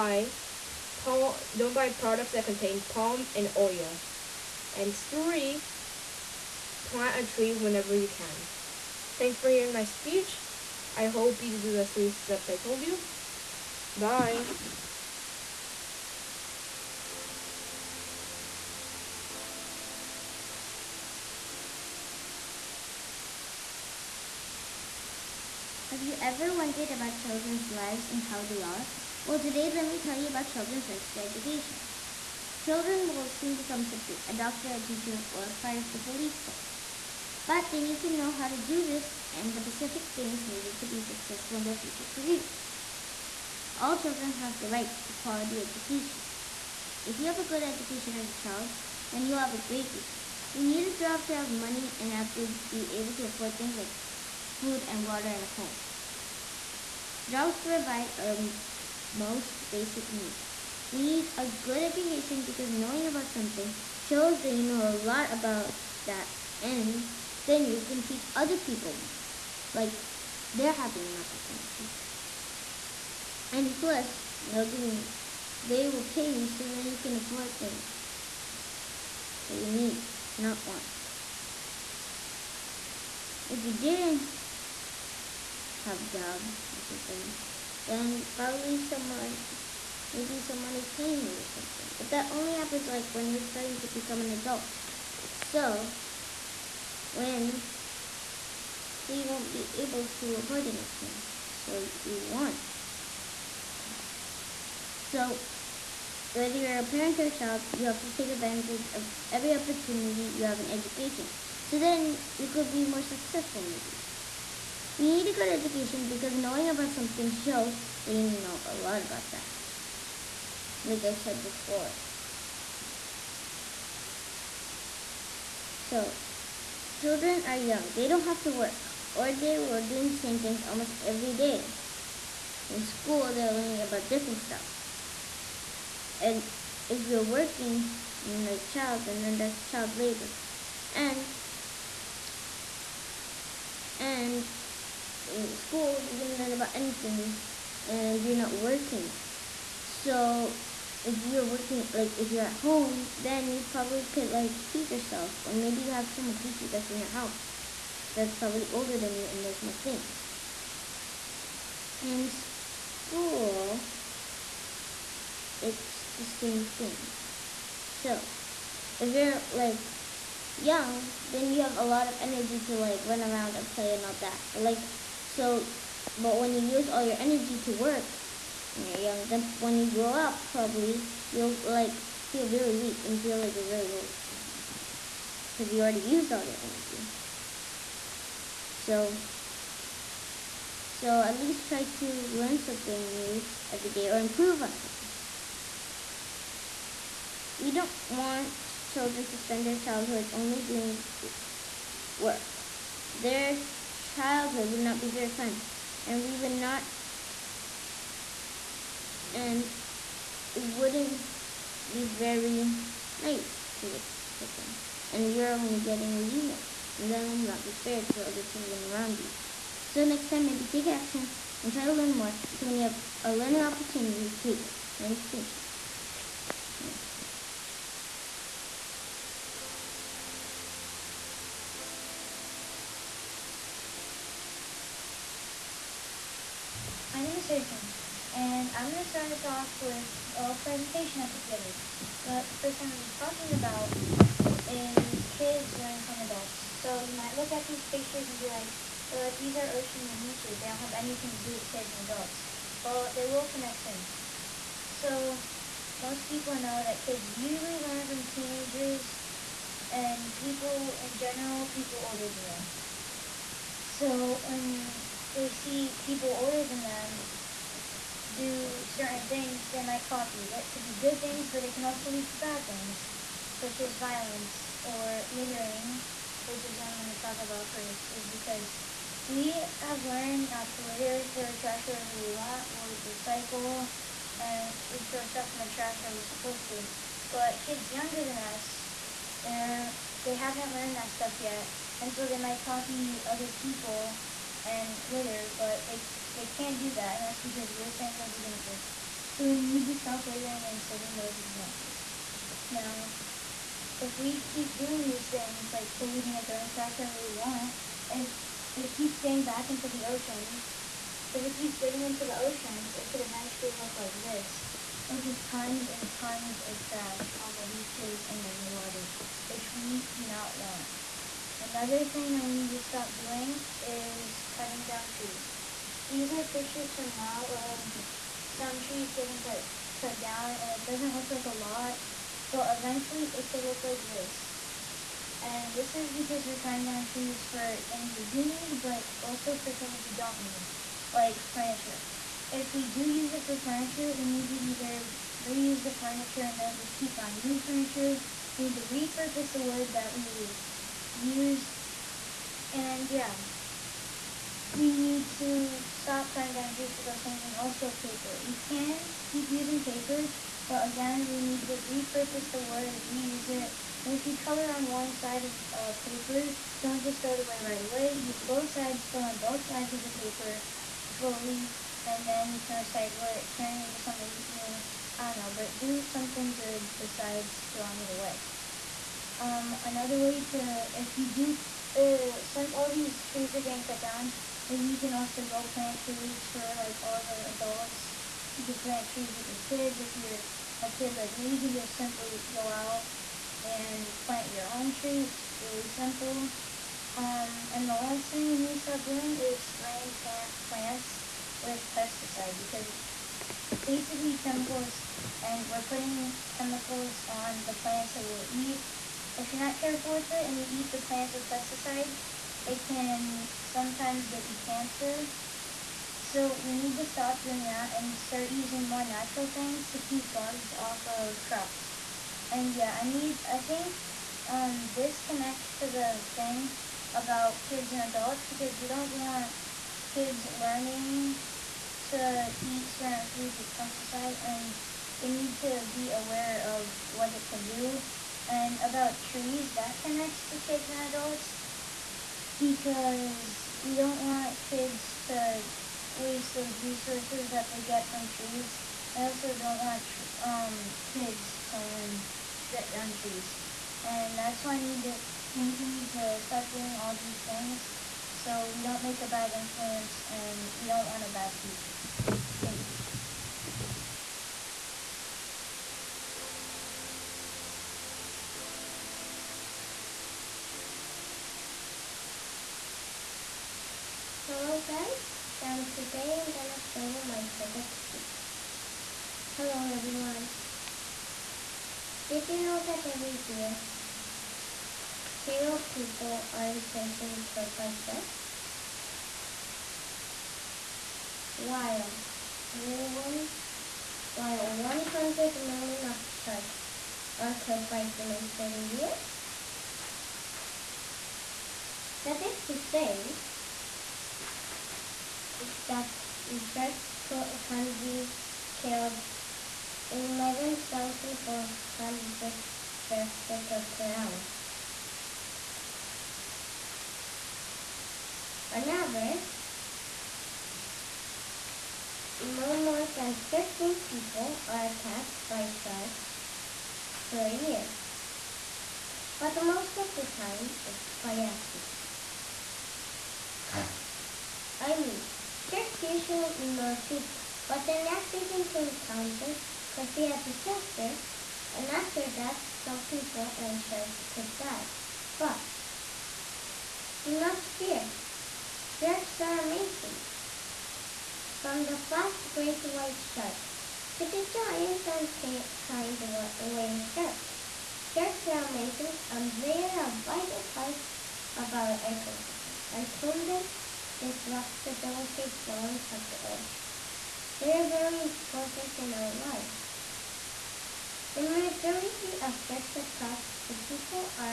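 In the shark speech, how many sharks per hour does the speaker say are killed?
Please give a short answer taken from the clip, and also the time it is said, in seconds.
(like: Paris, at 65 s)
11,400, at 510 s.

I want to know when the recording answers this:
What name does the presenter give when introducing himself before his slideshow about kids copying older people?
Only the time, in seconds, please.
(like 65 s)
237 s.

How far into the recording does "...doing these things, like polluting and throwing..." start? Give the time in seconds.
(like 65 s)
304 s.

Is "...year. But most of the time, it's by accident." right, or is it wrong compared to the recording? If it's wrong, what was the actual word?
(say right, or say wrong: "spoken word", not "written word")
right.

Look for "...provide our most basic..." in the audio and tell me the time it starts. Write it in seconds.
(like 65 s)
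57 s.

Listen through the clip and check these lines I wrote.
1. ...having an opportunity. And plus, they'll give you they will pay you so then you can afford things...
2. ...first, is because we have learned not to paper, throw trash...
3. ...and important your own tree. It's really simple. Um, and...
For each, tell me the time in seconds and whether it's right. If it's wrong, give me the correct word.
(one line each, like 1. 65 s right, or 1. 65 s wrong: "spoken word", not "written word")
1. 70 s right
2. 277 s wrong: "litter", not "paper"
3. 393 s wrong: "plant", not "important".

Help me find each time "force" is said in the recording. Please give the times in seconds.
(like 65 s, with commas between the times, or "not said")
36 s.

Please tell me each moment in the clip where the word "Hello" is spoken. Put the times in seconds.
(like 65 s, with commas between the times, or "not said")
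474 s, 479 s.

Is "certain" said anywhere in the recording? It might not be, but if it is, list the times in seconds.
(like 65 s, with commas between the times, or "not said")
268 s, 432 s.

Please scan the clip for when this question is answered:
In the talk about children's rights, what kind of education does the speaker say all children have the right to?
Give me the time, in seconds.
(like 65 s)
45 s.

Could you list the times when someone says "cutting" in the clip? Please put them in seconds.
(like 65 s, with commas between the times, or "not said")
324 s, 336 s, 356 s.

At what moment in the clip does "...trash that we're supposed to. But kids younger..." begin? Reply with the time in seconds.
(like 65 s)
285 s.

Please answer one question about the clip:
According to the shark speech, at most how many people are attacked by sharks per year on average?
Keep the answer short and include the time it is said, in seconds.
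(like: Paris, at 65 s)
15, at 523 s.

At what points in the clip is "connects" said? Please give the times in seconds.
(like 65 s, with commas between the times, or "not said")
253 s, 425 s, 440 s.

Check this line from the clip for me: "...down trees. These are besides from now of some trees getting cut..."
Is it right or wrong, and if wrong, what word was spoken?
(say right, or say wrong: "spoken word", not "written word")
wrong: "pictures", not "besides".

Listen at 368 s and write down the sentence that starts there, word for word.
Use both sides, fill in both sides of the paper fully, and then you can recycle it, turn it into something new.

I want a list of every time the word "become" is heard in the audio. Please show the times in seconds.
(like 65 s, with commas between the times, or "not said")
33 s, 93 s.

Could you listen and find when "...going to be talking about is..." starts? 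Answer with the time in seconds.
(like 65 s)
242 s.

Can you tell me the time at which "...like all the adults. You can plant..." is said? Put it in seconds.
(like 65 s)
386 s.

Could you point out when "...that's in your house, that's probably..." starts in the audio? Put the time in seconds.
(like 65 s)
156 s.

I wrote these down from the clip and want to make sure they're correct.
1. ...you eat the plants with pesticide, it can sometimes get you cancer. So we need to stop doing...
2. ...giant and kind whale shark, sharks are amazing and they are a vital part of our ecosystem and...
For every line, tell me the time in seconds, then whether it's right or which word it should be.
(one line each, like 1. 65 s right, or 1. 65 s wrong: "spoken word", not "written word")
1. 410 s right
2. 554 s right.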